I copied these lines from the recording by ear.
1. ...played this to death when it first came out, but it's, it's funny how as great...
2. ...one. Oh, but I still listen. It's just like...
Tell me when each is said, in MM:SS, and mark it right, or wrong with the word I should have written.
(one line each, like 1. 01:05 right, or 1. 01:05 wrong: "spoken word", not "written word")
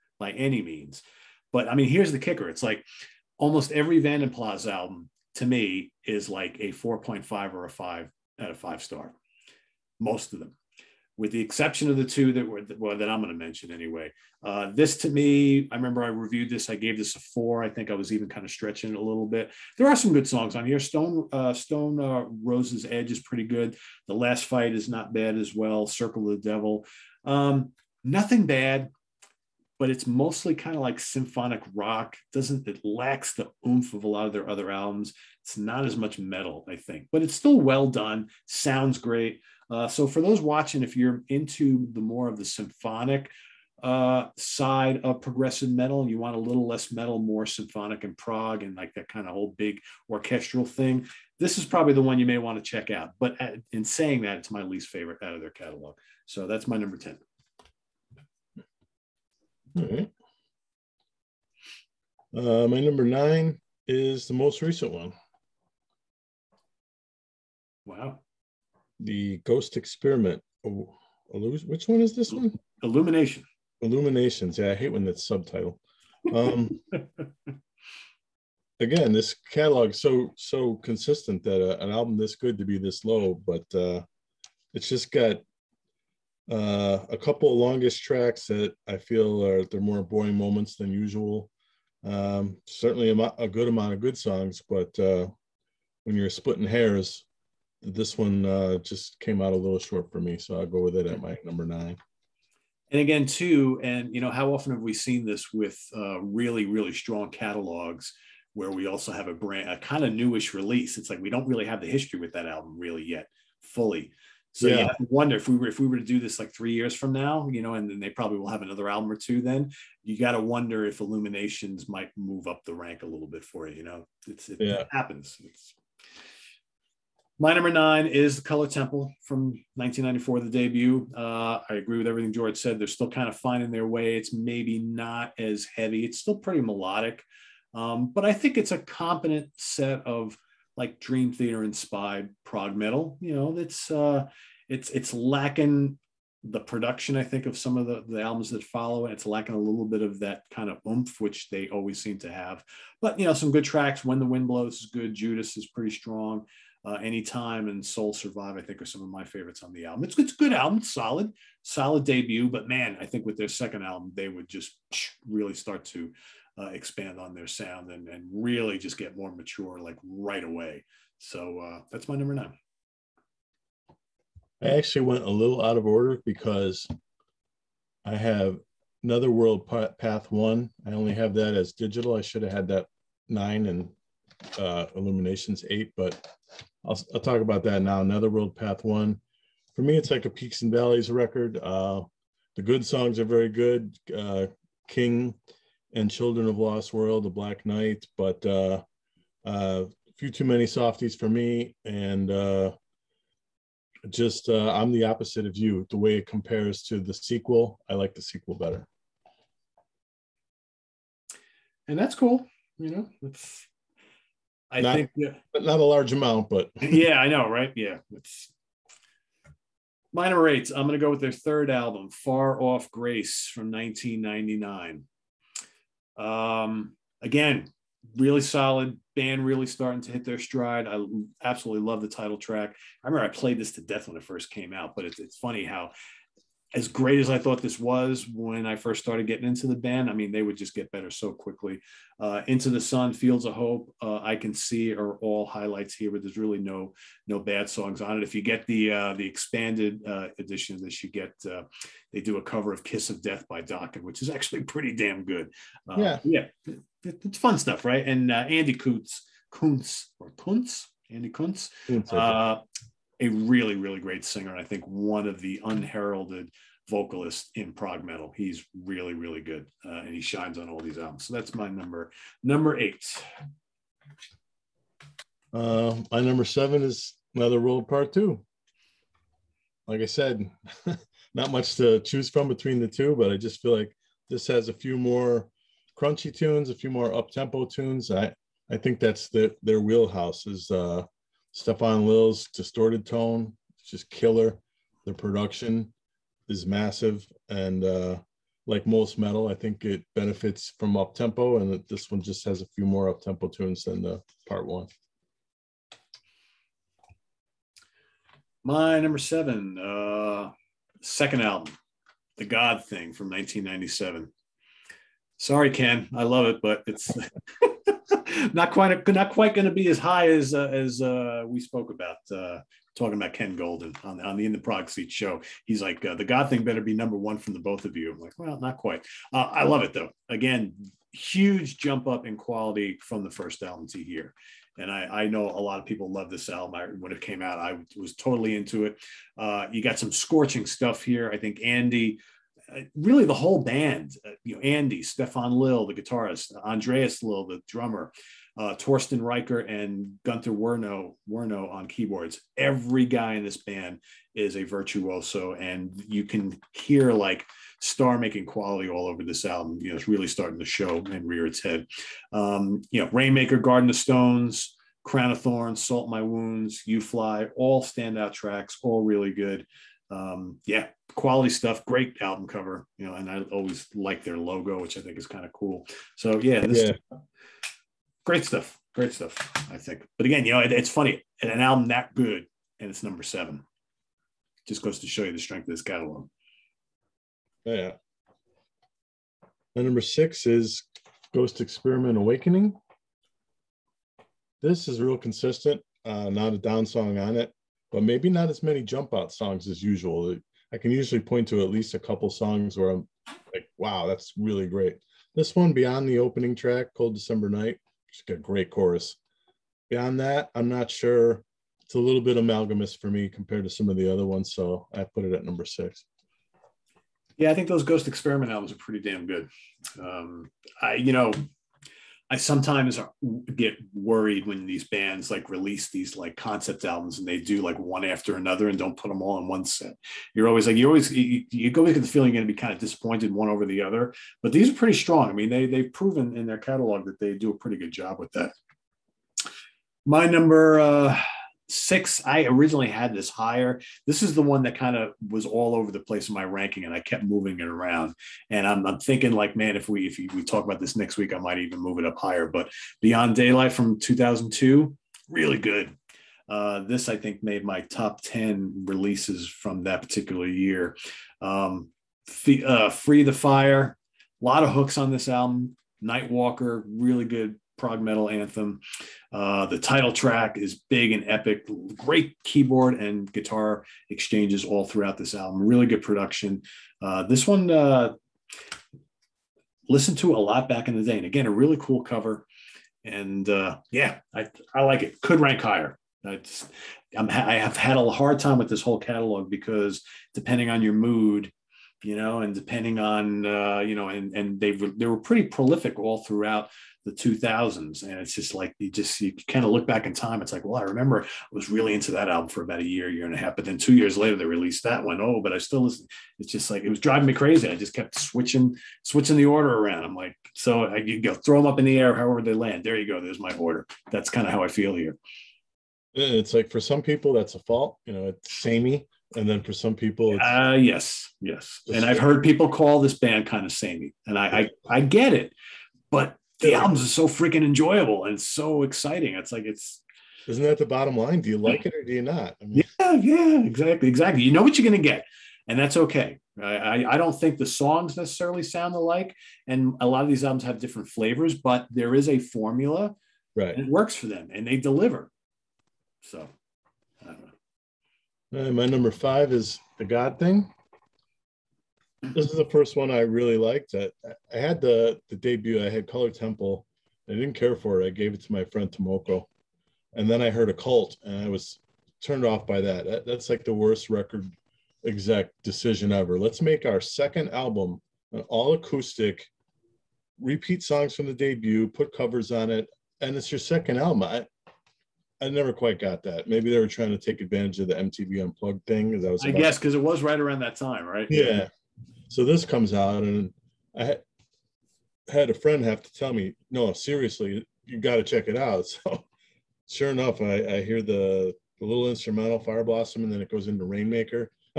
1. 03:53 right
2. 08:25 right.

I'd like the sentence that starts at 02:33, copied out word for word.
But you know, some good tracks.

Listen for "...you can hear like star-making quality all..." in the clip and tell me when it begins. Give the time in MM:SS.
05:56.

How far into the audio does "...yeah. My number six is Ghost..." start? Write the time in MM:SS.
06:27.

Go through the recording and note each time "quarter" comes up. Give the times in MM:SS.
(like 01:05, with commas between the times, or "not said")
not said.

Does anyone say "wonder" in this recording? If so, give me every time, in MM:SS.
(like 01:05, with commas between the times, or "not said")
01:55, 02:00.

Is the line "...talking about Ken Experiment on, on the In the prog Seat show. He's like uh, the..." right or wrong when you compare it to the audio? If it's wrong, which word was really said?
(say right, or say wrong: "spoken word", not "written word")
wrong: "Golden", not "Experiment".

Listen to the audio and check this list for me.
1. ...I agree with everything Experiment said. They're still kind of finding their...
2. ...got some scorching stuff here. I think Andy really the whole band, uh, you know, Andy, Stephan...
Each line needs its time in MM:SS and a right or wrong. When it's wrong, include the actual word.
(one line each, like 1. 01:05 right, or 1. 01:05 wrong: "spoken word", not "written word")
1. 02:11 wrong: "George", not "Experiment"
2. 05:39 right.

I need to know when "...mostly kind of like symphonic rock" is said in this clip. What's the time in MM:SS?
00:30.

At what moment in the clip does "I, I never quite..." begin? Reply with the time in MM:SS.
09:34.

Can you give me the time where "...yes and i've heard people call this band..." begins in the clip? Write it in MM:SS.
08:41.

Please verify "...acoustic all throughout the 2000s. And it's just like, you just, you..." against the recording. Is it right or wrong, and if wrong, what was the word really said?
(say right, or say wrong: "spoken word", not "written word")
wrong: "prolific", not "acoustic".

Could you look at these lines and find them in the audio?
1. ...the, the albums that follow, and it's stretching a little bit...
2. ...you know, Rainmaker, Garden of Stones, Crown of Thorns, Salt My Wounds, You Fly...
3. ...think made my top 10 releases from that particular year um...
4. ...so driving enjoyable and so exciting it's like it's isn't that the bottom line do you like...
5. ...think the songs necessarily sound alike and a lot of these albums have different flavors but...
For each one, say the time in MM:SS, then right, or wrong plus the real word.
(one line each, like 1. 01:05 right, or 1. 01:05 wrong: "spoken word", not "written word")
1. 02:27 wrong: "lacking", not "stretching"
2. 06:02 right
3. 07:37 right
4. 08:47 wrong: "freaking", not "driving"
5. 08:57 right.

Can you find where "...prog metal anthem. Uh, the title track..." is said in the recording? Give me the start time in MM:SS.
07:47.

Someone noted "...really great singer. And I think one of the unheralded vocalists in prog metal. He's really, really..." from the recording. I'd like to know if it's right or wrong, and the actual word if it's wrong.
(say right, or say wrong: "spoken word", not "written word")
right.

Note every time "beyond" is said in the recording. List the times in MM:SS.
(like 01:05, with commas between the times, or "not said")
06:45, 06:49, 07:33.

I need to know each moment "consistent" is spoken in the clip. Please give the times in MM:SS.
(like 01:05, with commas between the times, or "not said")
01:20, 06:35.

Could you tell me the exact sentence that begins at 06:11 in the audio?
Great album cover, you know, and I always like their logo, which I think is kind of cool.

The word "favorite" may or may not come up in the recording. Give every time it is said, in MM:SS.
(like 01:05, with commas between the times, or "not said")
00:54, 02:39.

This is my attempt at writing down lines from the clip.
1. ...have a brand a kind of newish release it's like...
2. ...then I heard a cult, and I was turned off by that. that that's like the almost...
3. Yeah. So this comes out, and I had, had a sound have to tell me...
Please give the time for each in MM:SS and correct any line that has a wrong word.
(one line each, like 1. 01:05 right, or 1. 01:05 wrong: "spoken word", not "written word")
1. 01:49 right
2. 09:20 wrong: "worst", not "almost"
3. 09:41 wrong: "friend", not "sound".